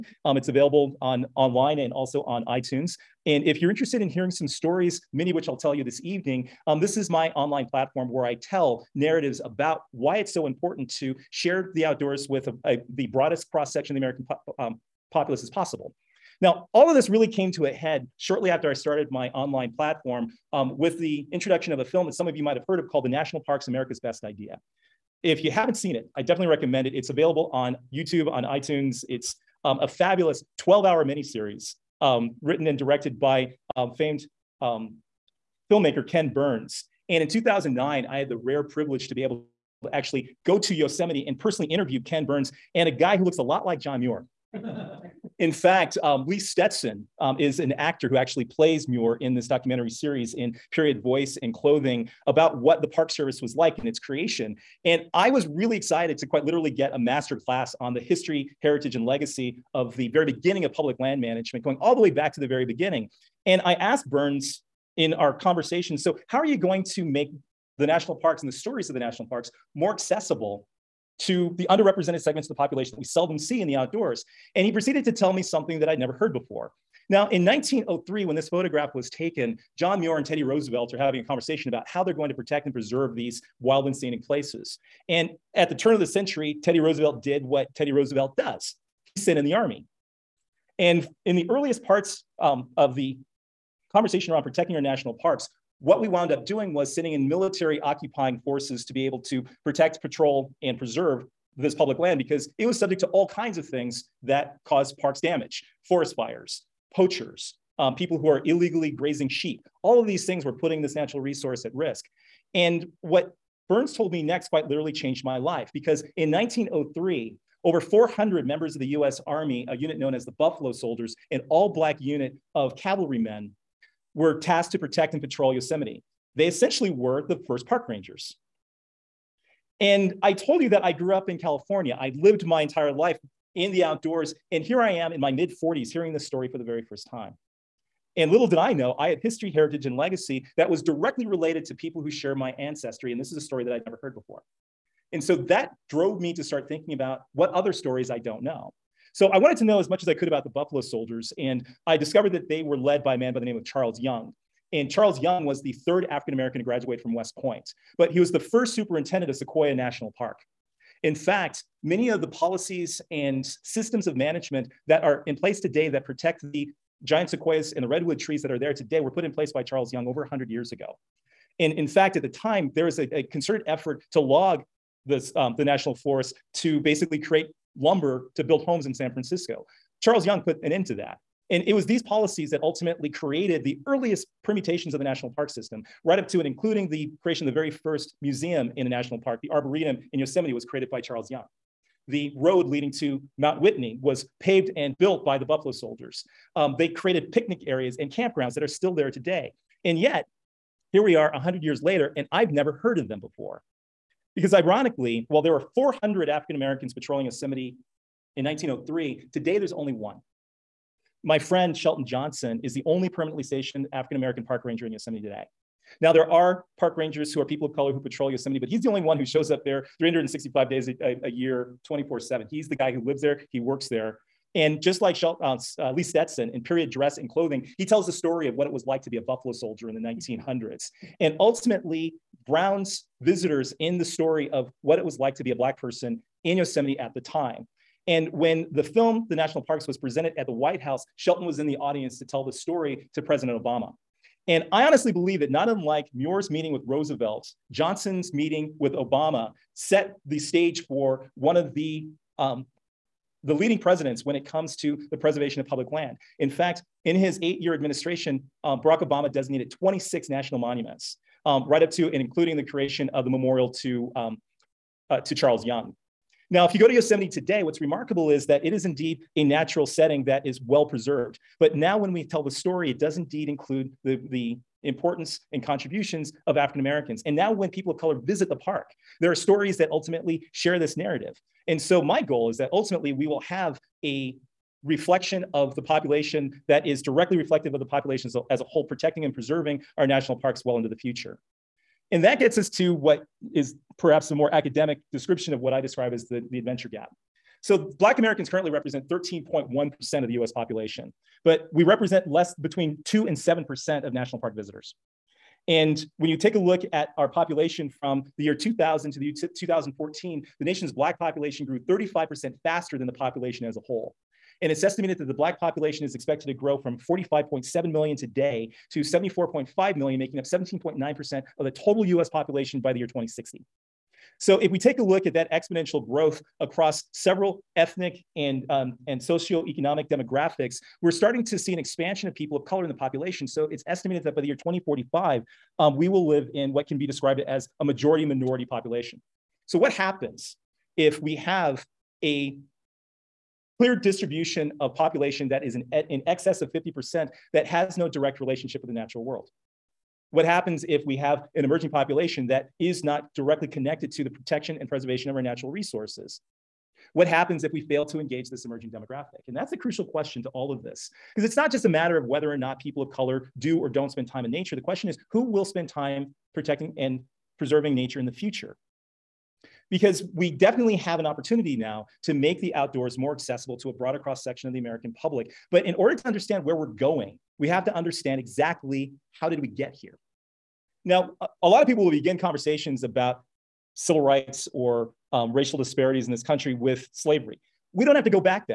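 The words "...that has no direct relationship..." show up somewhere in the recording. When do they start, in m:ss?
5:47.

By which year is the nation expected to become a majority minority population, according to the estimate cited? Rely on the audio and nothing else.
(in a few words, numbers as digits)
2045.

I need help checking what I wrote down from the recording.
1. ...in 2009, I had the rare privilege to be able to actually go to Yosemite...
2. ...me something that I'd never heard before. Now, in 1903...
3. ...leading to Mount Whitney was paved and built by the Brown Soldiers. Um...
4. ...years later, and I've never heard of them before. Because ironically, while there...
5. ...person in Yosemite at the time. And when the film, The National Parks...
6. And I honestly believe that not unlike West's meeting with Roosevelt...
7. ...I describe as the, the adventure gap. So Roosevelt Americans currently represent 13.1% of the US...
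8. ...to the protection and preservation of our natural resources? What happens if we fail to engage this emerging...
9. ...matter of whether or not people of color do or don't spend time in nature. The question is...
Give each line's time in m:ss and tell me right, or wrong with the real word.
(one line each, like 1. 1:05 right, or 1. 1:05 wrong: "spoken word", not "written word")
1. 0:37 right
2. 1:15 right
3. 3:12 wrong: "Buffalo", not "Brown"
4. 3:21 right
5. 3:55 right
6. 4:04 wrong: "Muir", not "West"
7. 4:55 wrong: "Black", not "Roosevelt"
8. 5:54 right
9. 6:01 right.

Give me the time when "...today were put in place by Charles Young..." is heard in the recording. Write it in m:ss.
2:48.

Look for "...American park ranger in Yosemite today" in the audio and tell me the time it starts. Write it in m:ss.
3:34.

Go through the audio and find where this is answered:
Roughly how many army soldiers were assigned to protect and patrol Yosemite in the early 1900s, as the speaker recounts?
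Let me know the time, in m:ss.
1:57.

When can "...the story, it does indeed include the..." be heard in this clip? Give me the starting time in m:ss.
4:32.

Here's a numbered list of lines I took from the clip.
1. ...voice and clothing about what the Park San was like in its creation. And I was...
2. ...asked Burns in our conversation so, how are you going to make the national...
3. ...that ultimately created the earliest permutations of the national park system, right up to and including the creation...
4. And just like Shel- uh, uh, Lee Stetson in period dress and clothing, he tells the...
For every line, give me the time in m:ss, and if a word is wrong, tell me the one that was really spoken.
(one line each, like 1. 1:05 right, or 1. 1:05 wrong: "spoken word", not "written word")
1. 0:51 wrong: "Service", not "San"
2. 1:03 right
3. 3:02 right
4. 3:44 right.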